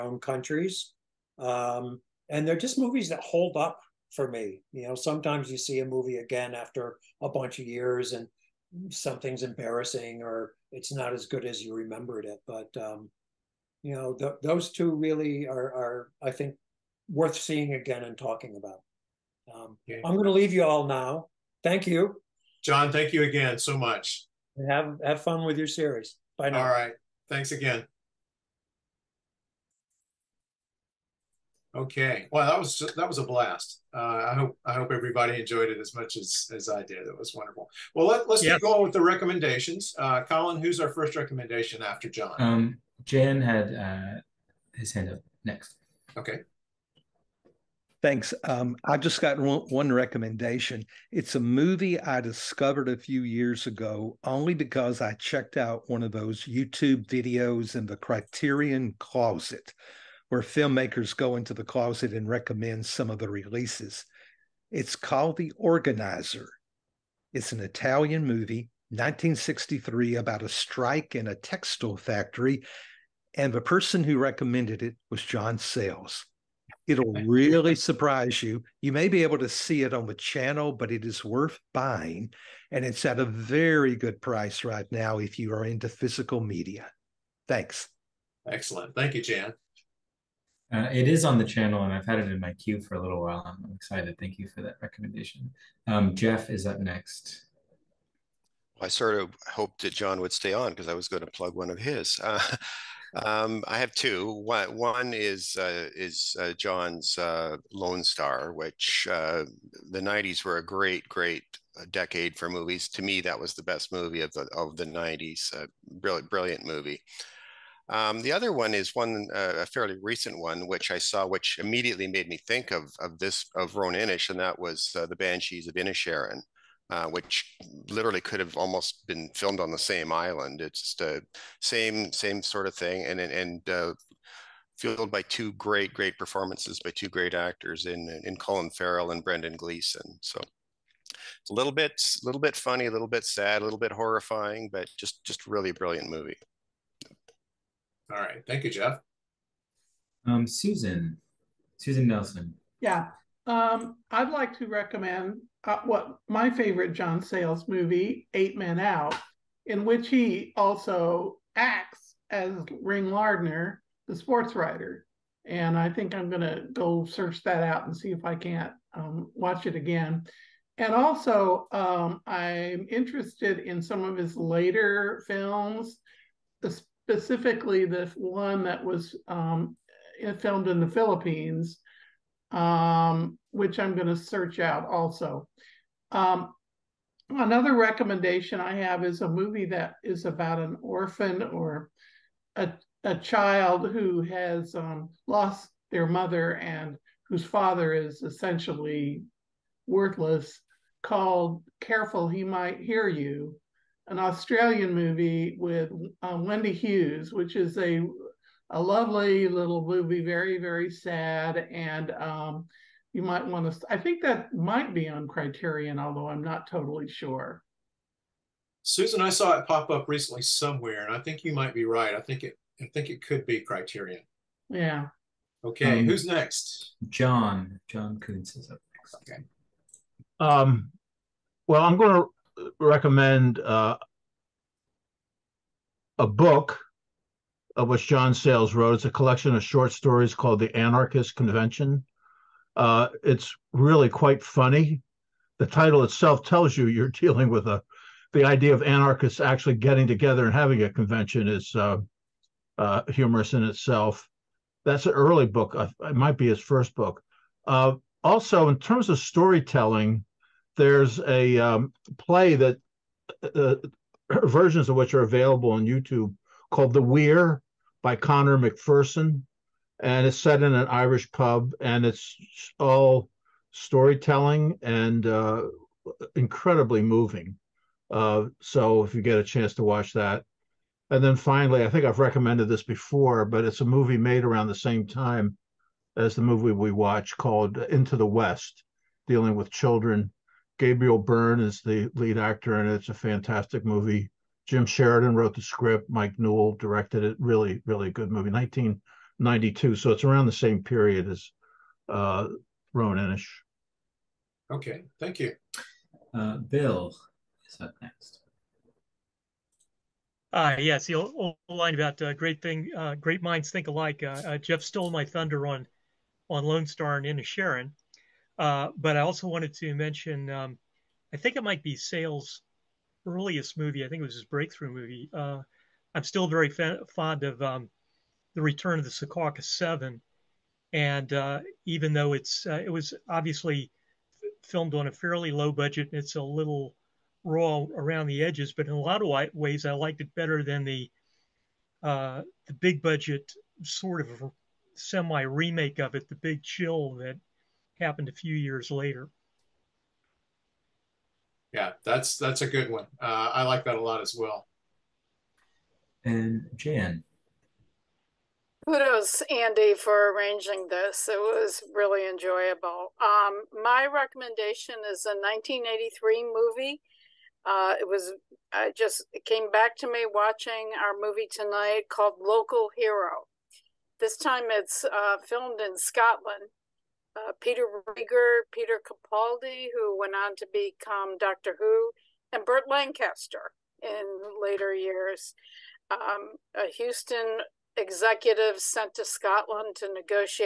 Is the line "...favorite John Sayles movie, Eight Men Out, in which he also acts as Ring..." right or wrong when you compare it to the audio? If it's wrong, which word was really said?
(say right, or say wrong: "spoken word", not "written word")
right.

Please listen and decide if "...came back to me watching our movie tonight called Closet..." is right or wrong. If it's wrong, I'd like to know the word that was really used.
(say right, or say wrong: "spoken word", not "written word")
wrong: "Local", not "Closet".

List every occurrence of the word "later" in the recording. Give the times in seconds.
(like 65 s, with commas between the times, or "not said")
174 s, 348 s, 384 s.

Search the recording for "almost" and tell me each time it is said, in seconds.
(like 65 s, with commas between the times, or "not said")
128 s.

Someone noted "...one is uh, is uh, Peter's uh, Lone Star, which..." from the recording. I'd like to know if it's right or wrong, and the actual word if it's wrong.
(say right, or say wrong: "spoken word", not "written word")
wrong: "John", not "Peter".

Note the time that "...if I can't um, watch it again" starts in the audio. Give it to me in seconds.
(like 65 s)
168 s.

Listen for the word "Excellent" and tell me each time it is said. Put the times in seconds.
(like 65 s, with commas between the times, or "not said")
88 s.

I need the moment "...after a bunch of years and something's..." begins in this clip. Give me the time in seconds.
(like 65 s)
6 s.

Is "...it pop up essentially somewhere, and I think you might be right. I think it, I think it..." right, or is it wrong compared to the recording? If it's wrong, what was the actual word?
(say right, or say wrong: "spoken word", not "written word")
wrong: "recently", not "essentially".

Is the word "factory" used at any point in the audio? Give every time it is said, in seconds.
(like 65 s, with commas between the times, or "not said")
71 s.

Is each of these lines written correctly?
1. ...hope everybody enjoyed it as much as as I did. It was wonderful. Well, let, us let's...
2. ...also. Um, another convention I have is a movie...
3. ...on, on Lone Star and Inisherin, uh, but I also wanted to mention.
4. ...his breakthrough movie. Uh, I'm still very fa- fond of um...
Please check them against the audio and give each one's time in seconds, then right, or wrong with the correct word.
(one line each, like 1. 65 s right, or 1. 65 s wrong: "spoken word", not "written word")
1. 34 s right
2. 184 s wrong: "recommendation", not "convention"
3. 315 s right
4. 324 s right.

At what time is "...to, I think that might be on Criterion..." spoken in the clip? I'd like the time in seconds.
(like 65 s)
213 s.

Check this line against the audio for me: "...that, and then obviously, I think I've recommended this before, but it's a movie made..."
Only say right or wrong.
wrong.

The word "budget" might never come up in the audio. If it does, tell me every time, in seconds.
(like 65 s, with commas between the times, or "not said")
335 s, 343 s.